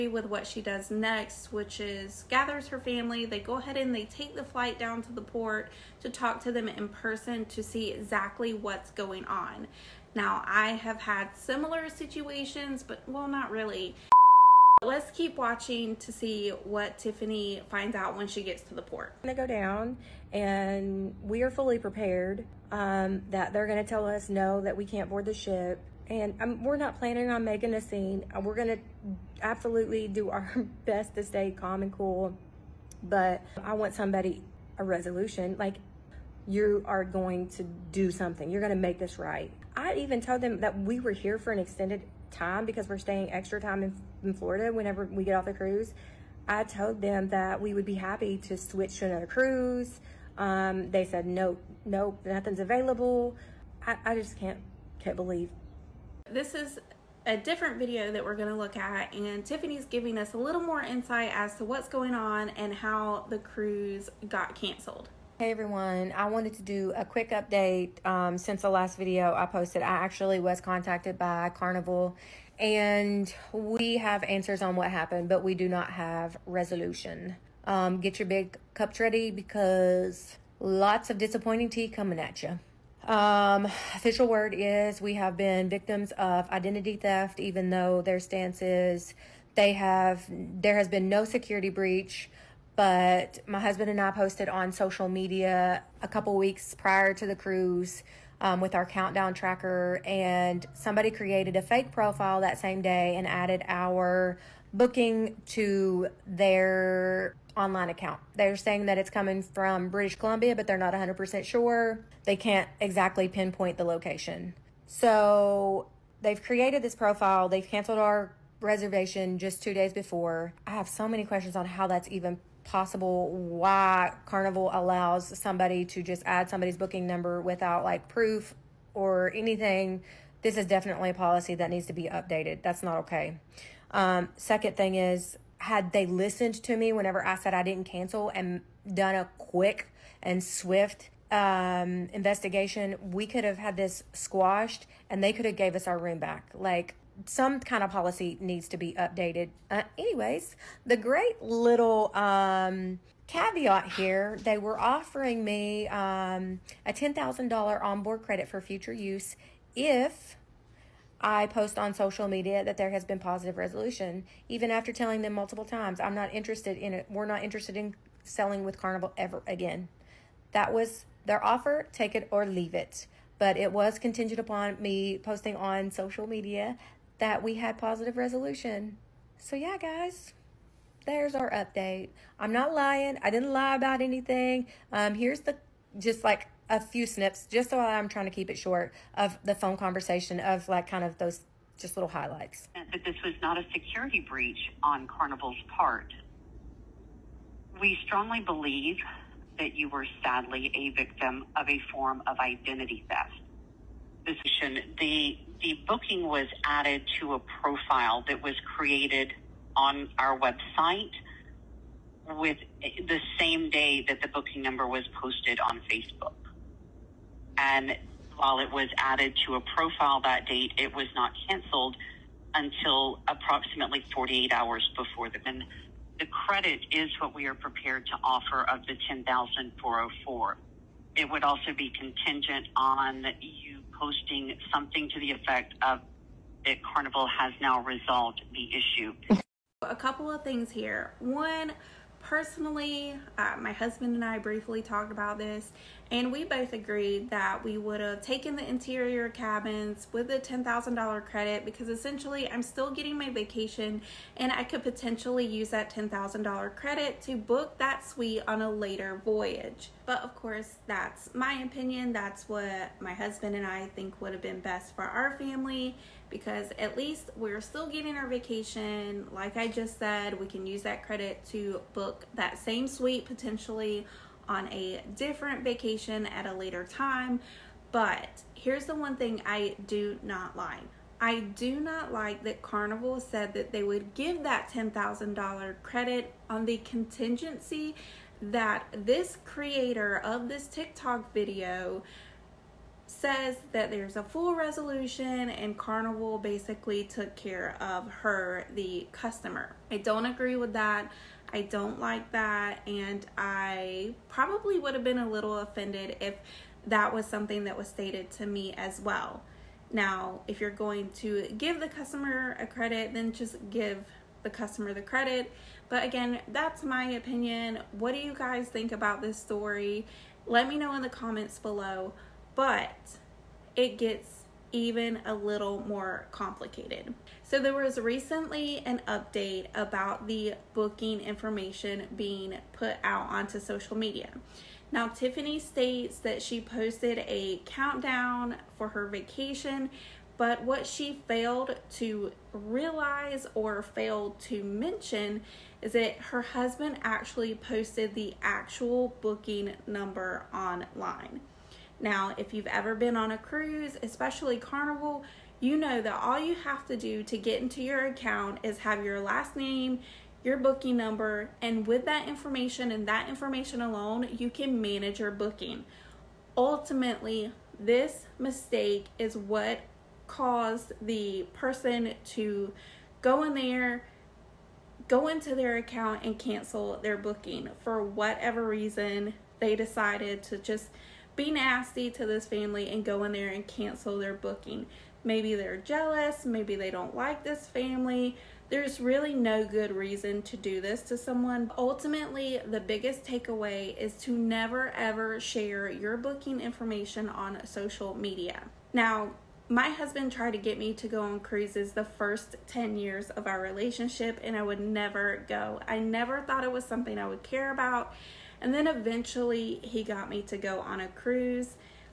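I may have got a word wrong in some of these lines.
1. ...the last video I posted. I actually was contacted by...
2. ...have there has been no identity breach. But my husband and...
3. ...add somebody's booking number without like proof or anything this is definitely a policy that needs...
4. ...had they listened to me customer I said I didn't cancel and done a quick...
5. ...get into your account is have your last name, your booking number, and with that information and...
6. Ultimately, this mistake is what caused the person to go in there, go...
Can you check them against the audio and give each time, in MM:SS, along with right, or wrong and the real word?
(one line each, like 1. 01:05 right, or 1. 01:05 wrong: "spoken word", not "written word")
1. 01:08 right
2. 01:29 wrong: "security", not "identity"
3. 02:06 right
4. 02:15 wrong: "whenever", not "customer"
5. 05:57 right
6. 06:06 right.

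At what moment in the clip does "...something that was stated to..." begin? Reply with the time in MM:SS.
05:07.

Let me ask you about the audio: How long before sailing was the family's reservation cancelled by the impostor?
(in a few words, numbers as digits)
Two days.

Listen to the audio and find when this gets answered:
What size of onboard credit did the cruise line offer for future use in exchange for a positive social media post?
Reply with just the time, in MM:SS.
02:36.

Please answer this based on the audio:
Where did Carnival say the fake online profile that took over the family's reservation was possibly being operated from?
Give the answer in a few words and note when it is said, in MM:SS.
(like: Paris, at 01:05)
British Columbia, at 01:49.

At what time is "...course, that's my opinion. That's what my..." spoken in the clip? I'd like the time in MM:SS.
04:20.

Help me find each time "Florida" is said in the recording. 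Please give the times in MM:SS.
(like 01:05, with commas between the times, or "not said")
00:44.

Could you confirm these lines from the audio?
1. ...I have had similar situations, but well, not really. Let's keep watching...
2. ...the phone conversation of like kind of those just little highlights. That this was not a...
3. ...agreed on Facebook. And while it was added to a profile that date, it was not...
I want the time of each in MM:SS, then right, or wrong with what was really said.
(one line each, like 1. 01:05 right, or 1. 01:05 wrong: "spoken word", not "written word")
1. 00:10 right
2. 03:09 right
3. 03:35 wrong: "posted", not "agreed".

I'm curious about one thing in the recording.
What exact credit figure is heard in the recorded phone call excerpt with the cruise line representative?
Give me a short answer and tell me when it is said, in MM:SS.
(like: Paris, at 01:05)
10,404, at 03:49.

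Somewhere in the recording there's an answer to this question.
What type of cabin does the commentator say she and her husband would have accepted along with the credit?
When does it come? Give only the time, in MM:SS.
04:08.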